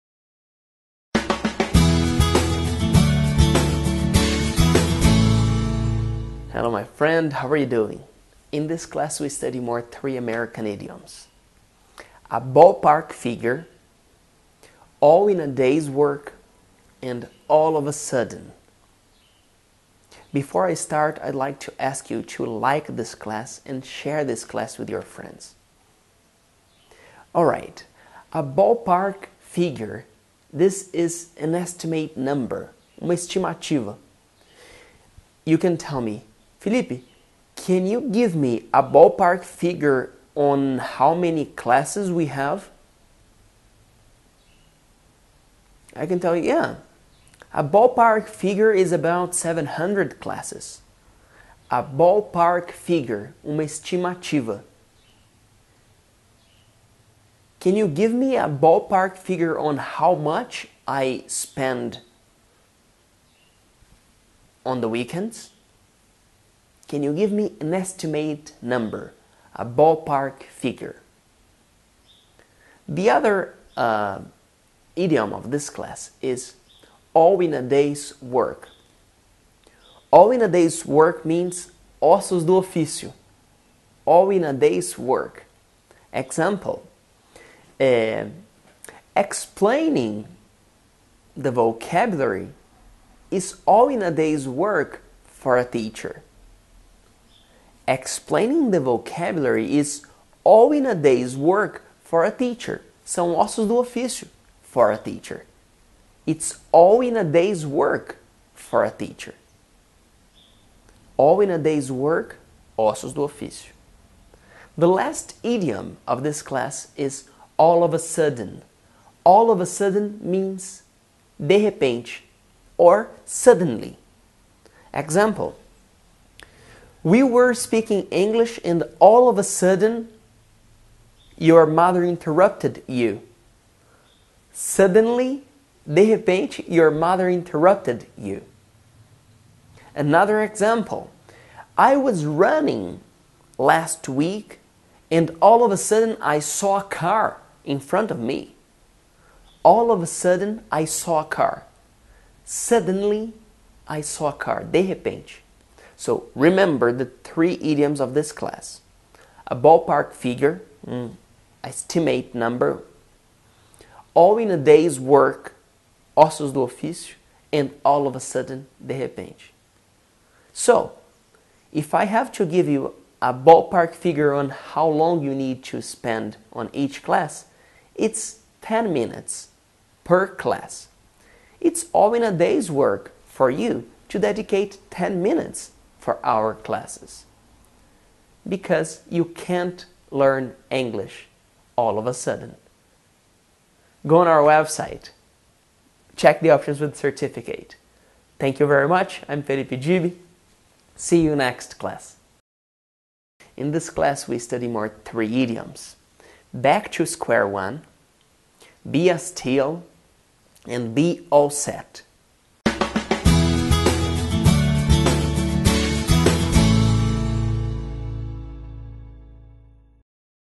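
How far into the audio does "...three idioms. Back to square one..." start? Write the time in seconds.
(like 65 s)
205 s.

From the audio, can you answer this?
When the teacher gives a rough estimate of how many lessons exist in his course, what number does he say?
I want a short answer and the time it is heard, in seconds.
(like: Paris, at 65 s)
700, at 48 s.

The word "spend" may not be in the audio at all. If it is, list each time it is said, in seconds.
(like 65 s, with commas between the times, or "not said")
61 s, 175 s.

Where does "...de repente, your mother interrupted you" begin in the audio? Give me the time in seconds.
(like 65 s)
135 s.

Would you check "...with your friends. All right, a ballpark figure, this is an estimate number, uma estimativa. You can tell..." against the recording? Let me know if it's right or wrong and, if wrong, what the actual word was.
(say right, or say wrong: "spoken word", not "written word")
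right.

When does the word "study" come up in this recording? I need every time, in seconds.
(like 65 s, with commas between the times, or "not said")
9 s, 204 s.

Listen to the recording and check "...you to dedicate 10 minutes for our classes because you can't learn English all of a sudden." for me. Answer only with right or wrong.
right.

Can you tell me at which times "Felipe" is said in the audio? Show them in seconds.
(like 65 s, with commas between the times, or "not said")
36 s, 199 s.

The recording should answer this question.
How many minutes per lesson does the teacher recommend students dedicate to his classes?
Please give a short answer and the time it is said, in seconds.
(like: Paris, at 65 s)
10 minutes, at 178 s.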